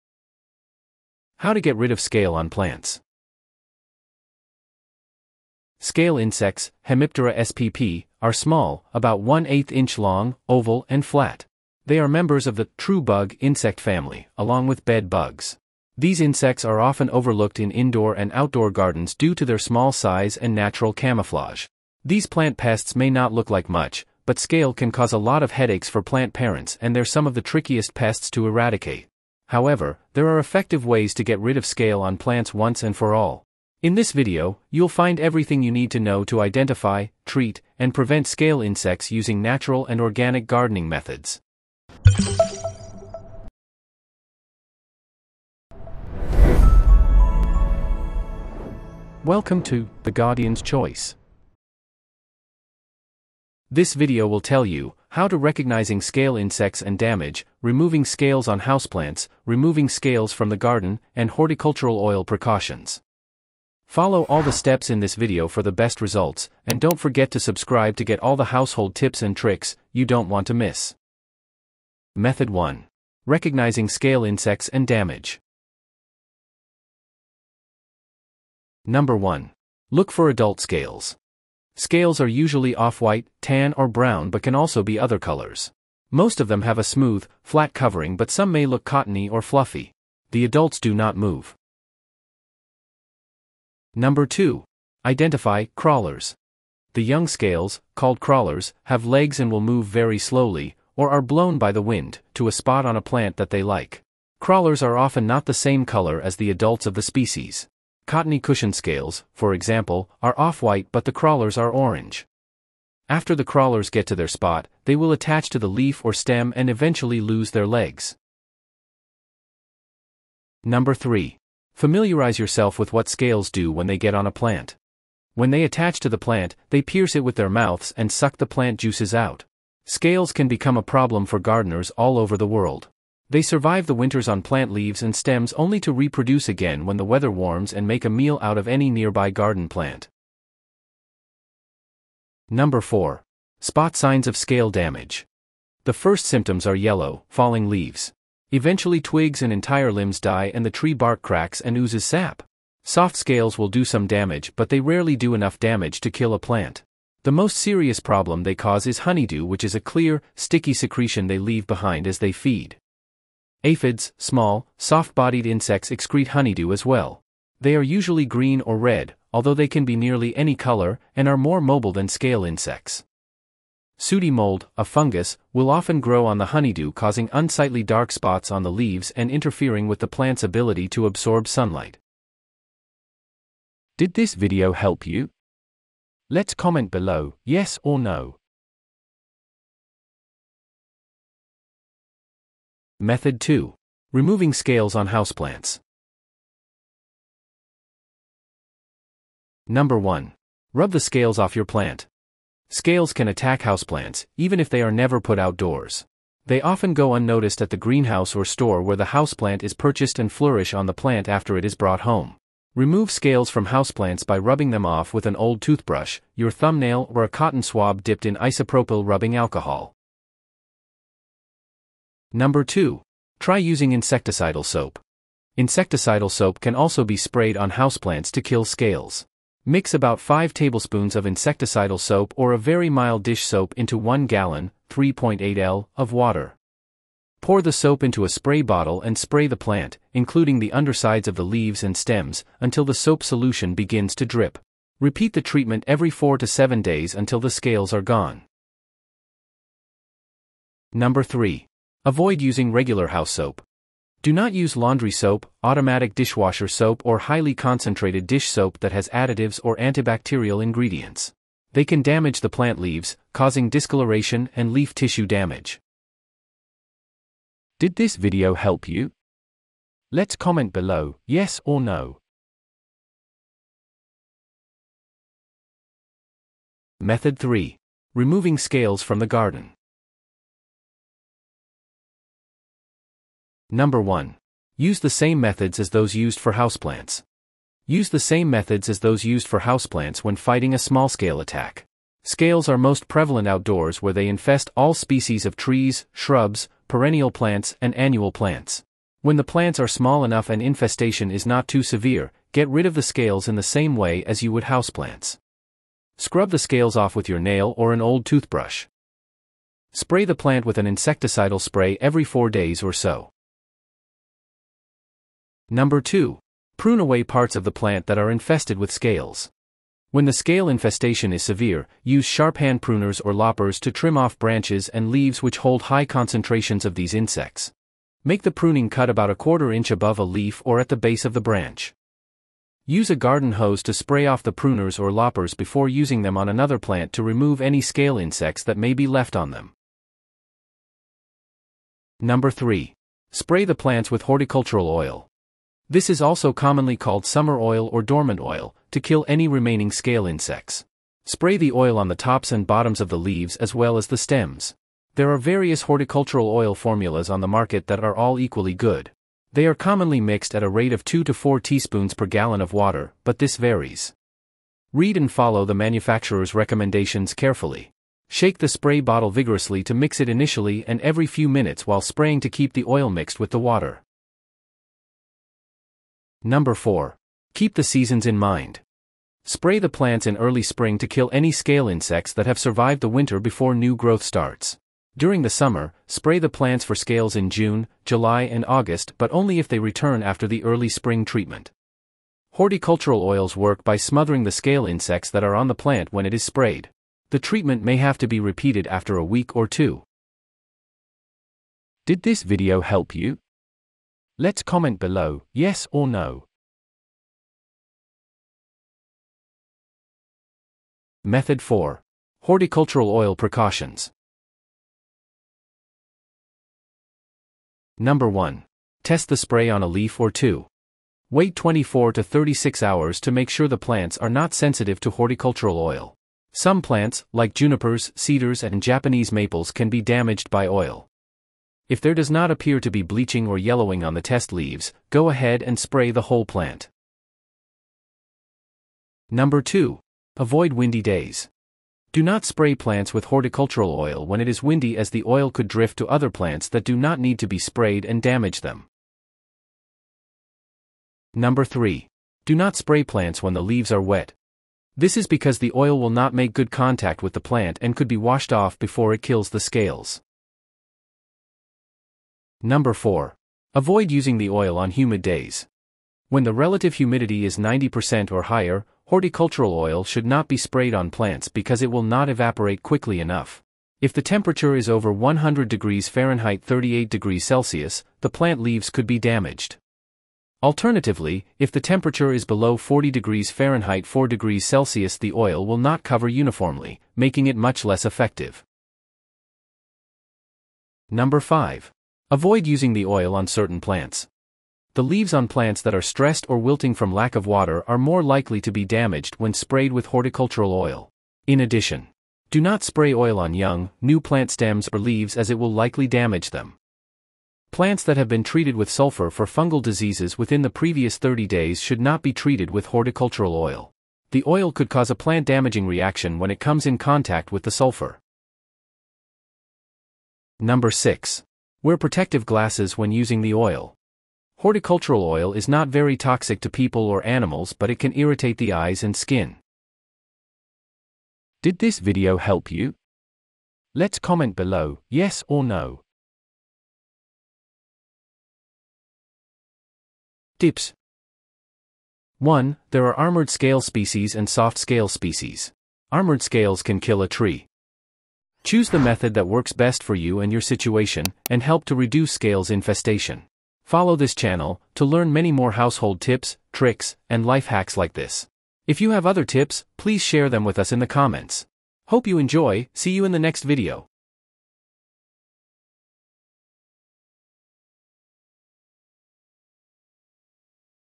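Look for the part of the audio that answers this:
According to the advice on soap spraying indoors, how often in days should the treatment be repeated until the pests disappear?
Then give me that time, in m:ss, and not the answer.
4:05.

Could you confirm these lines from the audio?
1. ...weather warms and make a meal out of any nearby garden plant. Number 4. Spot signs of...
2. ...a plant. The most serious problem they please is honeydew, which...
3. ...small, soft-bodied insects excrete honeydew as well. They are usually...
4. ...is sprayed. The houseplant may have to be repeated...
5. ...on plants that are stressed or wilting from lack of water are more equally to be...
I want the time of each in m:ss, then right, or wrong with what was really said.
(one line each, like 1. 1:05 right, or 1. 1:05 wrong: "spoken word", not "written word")
1. 2:17 right
2. 2:36 wrong: "cause", not "please"
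3. 2:44 right
4. 6:36 wrong: "treatment", not "houseplant"
5. 8:15 wrong: "likely", not "equally".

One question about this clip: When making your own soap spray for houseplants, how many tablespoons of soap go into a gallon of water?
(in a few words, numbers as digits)
5.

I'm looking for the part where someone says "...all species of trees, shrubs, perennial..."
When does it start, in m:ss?
4:54.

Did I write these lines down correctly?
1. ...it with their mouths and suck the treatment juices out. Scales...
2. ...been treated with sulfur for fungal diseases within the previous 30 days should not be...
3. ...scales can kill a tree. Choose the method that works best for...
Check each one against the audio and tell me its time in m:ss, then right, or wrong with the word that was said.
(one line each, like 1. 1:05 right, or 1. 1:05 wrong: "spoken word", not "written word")
1. 2:07 wrong: "plant", not "treatment"
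2. 8:28 right
3. 9:06 right.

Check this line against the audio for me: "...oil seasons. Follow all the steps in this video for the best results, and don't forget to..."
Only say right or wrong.
wrong.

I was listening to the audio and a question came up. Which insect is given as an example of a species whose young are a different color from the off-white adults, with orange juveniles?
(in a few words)
Cottony cushion scales.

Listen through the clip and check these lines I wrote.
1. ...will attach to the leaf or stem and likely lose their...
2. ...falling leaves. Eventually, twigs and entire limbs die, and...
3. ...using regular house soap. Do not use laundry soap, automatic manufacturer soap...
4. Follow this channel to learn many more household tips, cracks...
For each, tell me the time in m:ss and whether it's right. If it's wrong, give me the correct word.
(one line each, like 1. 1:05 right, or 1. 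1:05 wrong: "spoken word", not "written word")
1. 1:54 wrong: "eventually", not "likely"
2. 2:27 right
3. 4:12 wrong: "dishwasher", not "manufacturer"
4. 9:13 wrong: "tricks", not "cracks".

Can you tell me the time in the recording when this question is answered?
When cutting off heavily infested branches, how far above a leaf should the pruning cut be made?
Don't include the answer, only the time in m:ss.
5:29.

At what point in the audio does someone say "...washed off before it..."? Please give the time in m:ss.
7:38.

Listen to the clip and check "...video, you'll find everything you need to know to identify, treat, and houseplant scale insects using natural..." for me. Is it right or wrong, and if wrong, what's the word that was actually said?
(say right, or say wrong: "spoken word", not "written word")
wrong: "prevent", not "houseplant".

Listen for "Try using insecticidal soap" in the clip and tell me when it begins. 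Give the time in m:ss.
3:43.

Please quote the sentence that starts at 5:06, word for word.
Scrub the scales off with your nail or an old toothbrush.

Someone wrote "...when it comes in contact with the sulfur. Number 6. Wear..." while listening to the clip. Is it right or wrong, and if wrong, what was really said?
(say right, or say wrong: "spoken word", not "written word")
right.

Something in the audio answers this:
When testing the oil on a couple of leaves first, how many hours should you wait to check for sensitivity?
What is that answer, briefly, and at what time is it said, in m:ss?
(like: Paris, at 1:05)
24 to 36 hours, at 7:01.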